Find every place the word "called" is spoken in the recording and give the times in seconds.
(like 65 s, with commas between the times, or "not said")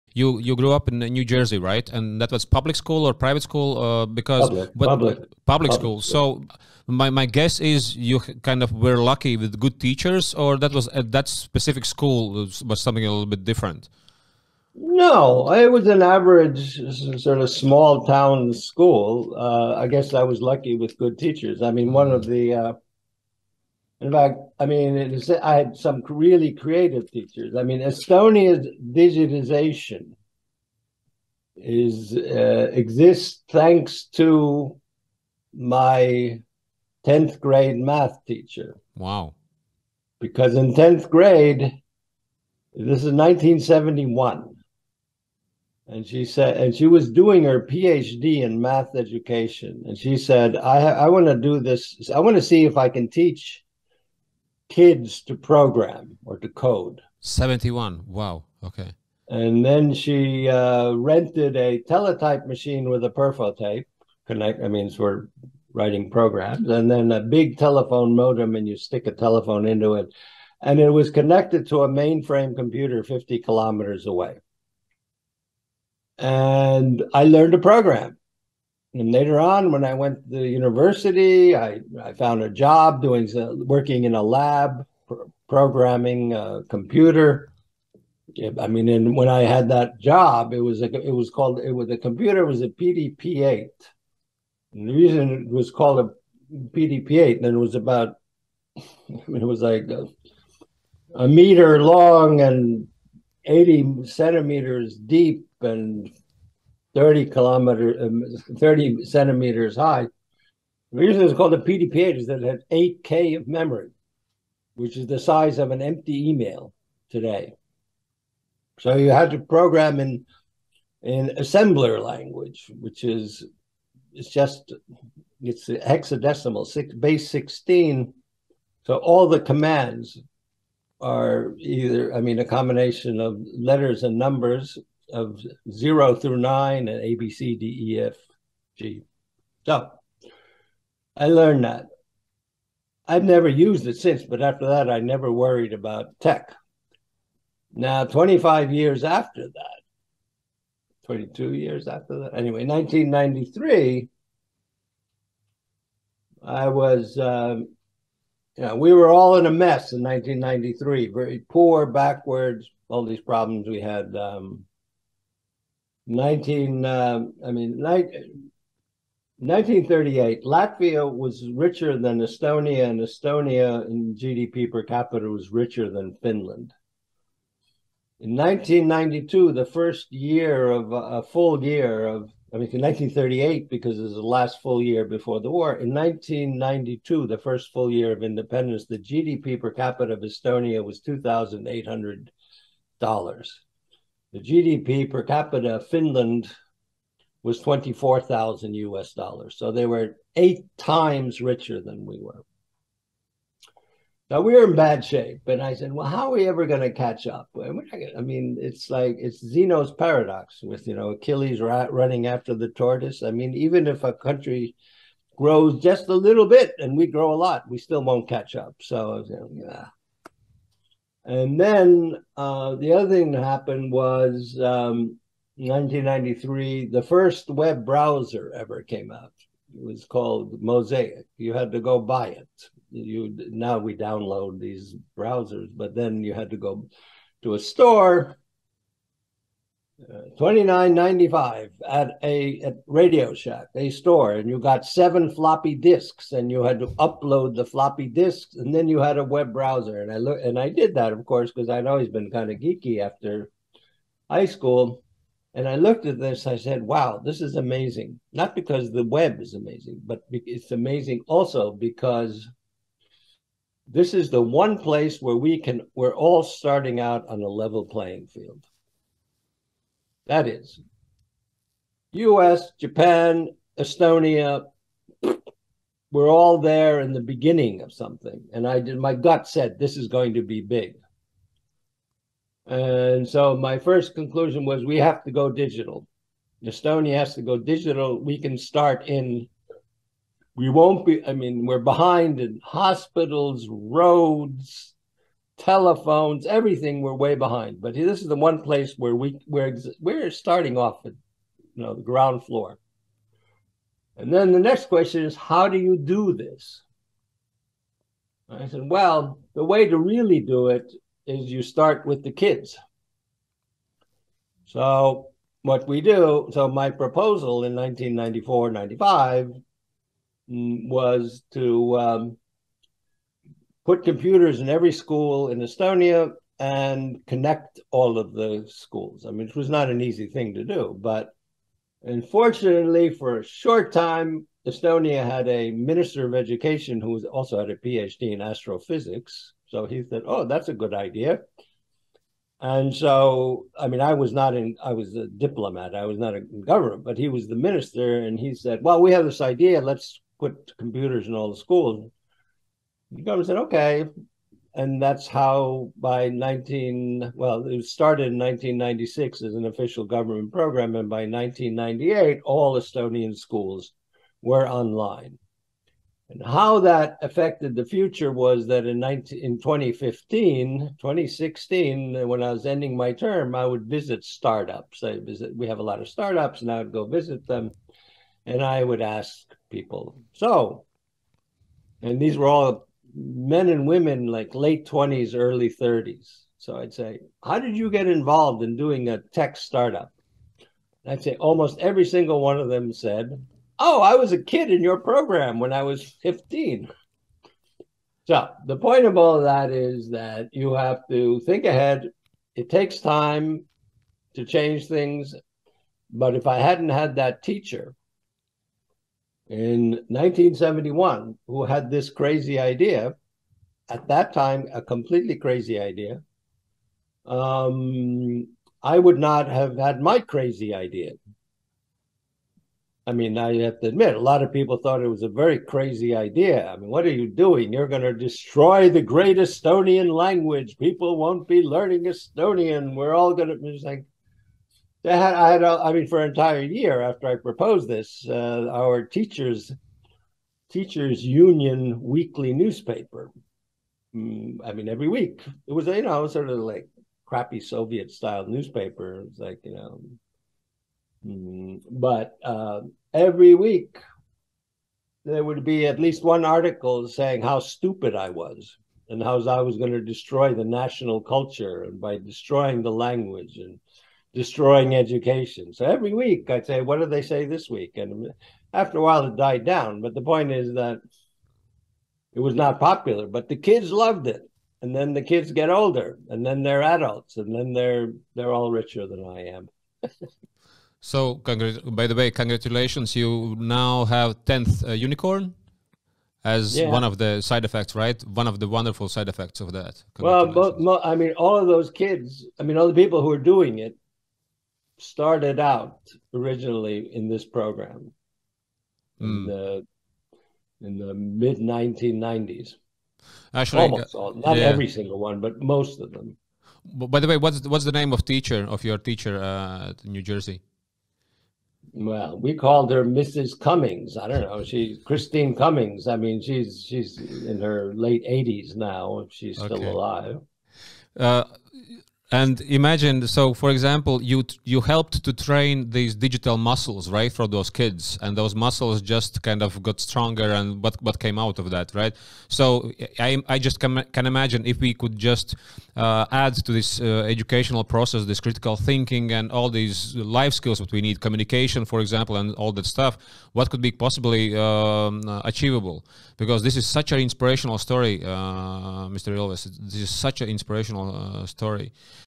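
91 s, 95 s, 111 s, 230 s, 512 s.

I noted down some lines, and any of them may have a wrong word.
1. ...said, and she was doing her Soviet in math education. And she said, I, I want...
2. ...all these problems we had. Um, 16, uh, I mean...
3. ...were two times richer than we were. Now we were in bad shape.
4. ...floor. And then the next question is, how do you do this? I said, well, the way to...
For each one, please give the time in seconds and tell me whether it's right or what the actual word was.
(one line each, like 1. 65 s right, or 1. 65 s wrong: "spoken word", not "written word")
1. 46 s wrong: "PhD", not "Soviet"
2. 162 s wrong: "19", not "16"
3. 199 s wrong: "eight", not "two"
4. 302 s right.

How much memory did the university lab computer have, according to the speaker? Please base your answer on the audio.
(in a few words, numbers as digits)
8K.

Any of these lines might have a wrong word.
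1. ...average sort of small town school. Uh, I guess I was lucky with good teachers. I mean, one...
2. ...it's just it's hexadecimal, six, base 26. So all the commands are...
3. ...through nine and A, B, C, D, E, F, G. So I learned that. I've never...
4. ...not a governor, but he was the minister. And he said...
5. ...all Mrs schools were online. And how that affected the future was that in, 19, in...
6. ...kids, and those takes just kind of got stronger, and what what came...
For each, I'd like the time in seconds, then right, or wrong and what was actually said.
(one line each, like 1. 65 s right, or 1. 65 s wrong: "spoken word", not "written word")
1. 16 s right
2. 124 s wrong: "16", not "26"
3. 136 s right
4. 346 s right
5. 362 s wrong: "Estonian", not "Mrs"
6. 527 s wrong: "muscles", not "takes".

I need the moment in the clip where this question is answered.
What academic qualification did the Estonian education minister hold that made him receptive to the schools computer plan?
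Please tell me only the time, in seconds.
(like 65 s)
337 s.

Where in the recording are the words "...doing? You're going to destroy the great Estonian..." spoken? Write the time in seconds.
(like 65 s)
427 s.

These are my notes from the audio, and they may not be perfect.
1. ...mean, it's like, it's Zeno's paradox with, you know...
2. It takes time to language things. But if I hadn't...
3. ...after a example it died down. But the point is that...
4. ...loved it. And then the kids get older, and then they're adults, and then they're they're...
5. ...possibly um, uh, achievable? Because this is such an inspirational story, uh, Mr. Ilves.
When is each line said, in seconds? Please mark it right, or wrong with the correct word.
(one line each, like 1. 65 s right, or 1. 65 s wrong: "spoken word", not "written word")
1. 208 s right
2. 402 s wrong: "change", not "language"
3. 468 s wrong: "while", not "example"
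4. 473 s right
5. 543 s right.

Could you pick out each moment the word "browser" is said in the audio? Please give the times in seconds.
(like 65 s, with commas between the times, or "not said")
227 s, 235 s, 249 s.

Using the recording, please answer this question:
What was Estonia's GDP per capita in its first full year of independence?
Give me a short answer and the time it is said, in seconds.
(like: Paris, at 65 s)
$2,800, at 191 s.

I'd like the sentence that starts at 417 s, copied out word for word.
Um, I would not have had my crazy idea.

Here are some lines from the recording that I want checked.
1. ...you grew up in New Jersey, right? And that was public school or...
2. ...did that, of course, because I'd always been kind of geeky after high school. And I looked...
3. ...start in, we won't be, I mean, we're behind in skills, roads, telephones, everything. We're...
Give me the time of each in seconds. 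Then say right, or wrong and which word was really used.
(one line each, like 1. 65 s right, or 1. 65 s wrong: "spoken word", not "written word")
1. 0 s right
2. 250 s right
3. 288 s wrong: "hospitals", not "skills".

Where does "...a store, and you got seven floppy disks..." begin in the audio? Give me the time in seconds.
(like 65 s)
243 s.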